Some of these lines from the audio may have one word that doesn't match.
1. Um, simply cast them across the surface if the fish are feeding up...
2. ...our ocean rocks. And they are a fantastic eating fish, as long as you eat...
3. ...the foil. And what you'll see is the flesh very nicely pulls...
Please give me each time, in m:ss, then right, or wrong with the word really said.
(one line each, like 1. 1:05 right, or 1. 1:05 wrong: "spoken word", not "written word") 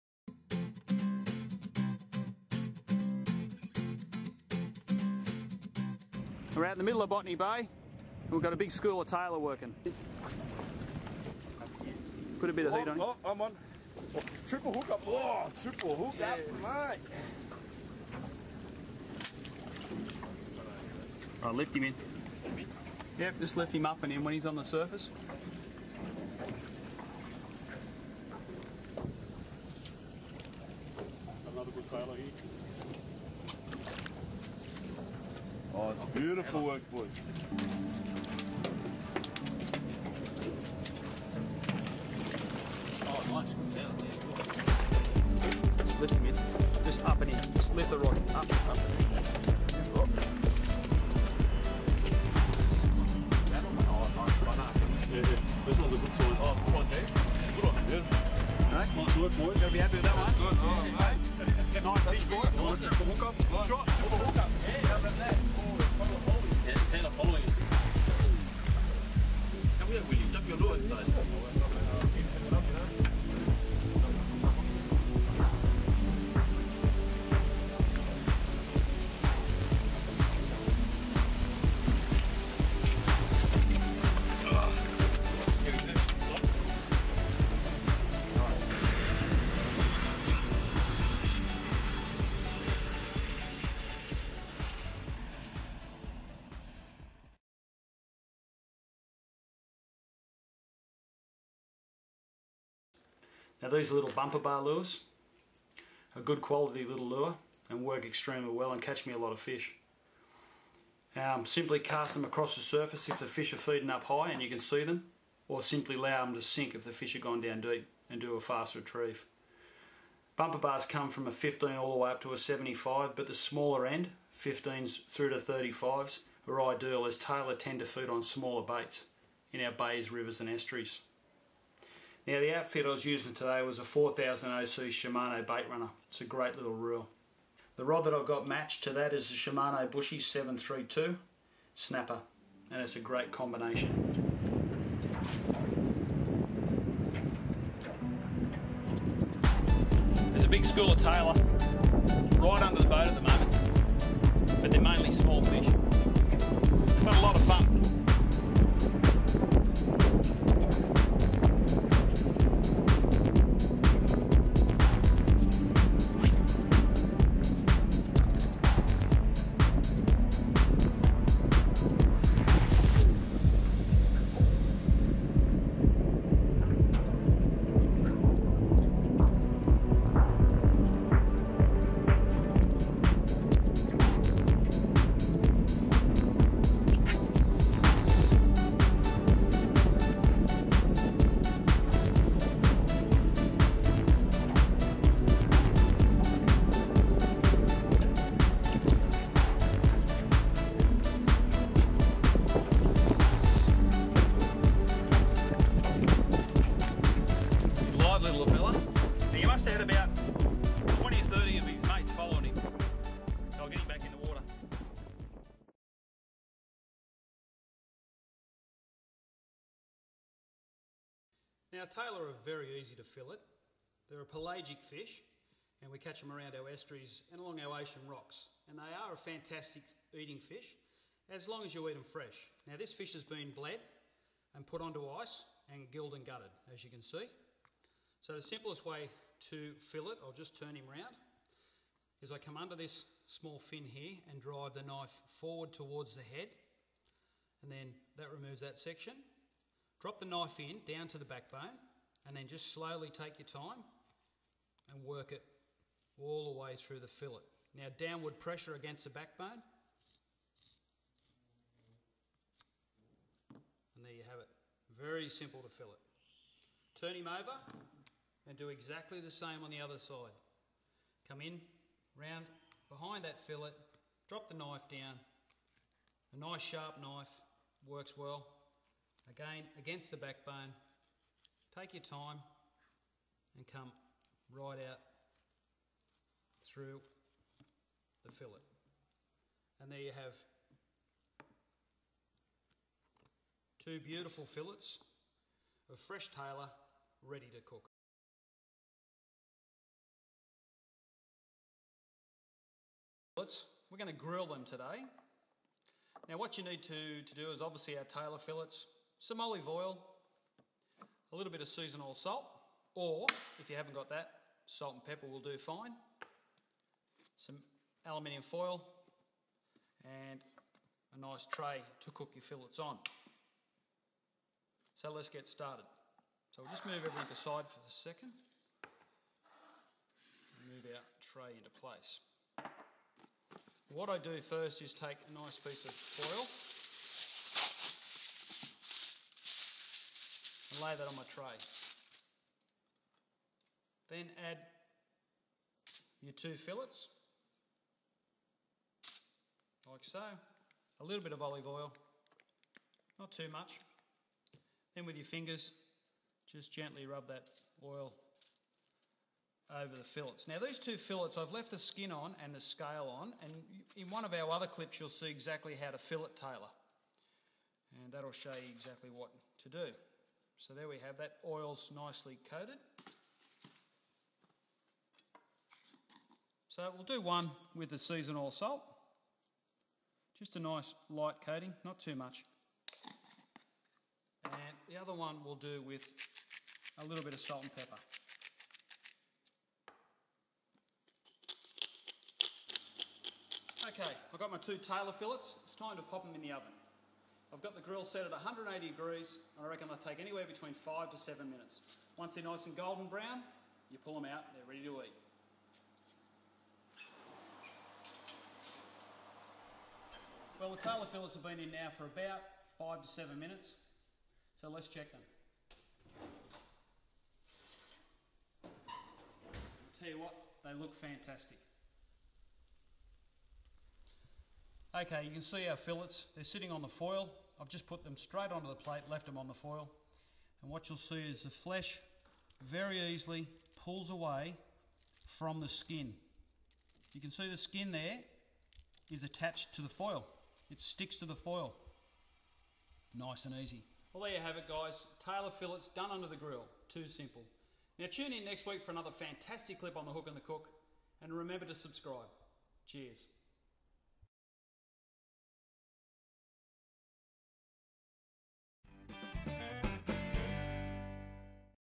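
1. 1:51 right
2. 3:47 right
3. 7:09 wrong: "easily", not "nicely".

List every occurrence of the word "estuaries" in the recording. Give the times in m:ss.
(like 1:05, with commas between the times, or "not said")
2:10, 3:46.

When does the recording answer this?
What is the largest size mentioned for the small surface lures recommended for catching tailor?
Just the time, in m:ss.
2:02.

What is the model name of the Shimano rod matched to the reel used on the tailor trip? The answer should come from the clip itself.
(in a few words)
Bushy 732 snapper.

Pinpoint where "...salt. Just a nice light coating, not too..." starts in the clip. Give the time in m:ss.
6:18.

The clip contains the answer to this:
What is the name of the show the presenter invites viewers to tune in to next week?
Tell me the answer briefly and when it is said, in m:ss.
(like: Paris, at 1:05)
The Hook and the Cook, at 7:30.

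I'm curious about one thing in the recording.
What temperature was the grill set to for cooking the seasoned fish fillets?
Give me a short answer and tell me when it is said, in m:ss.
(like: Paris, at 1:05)
180 degrees, at 6:38.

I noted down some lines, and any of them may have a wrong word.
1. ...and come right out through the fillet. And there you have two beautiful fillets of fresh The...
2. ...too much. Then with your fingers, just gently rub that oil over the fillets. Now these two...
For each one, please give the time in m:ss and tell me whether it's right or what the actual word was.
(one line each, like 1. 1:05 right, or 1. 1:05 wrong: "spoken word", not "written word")
1. 4:43 wrong: "Tailor", not "The"
2. 5:53 right.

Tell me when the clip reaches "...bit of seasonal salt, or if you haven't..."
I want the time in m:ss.
5:11.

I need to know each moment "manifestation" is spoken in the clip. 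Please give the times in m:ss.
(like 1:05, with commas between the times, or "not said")
not said.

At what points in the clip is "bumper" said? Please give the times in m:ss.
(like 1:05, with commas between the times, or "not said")
1:44, 2:00.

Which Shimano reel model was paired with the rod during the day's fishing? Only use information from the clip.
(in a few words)
4000 OC Shimano bait runner.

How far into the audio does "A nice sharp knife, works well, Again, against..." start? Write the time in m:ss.
4:36.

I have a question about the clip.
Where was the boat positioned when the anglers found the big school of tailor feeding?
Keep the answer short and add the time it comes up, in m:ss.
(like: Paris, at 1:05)
Botany Bay, at 0:07.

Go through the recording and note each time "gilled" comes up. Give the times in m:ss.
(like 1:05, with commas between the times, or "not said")
3:55.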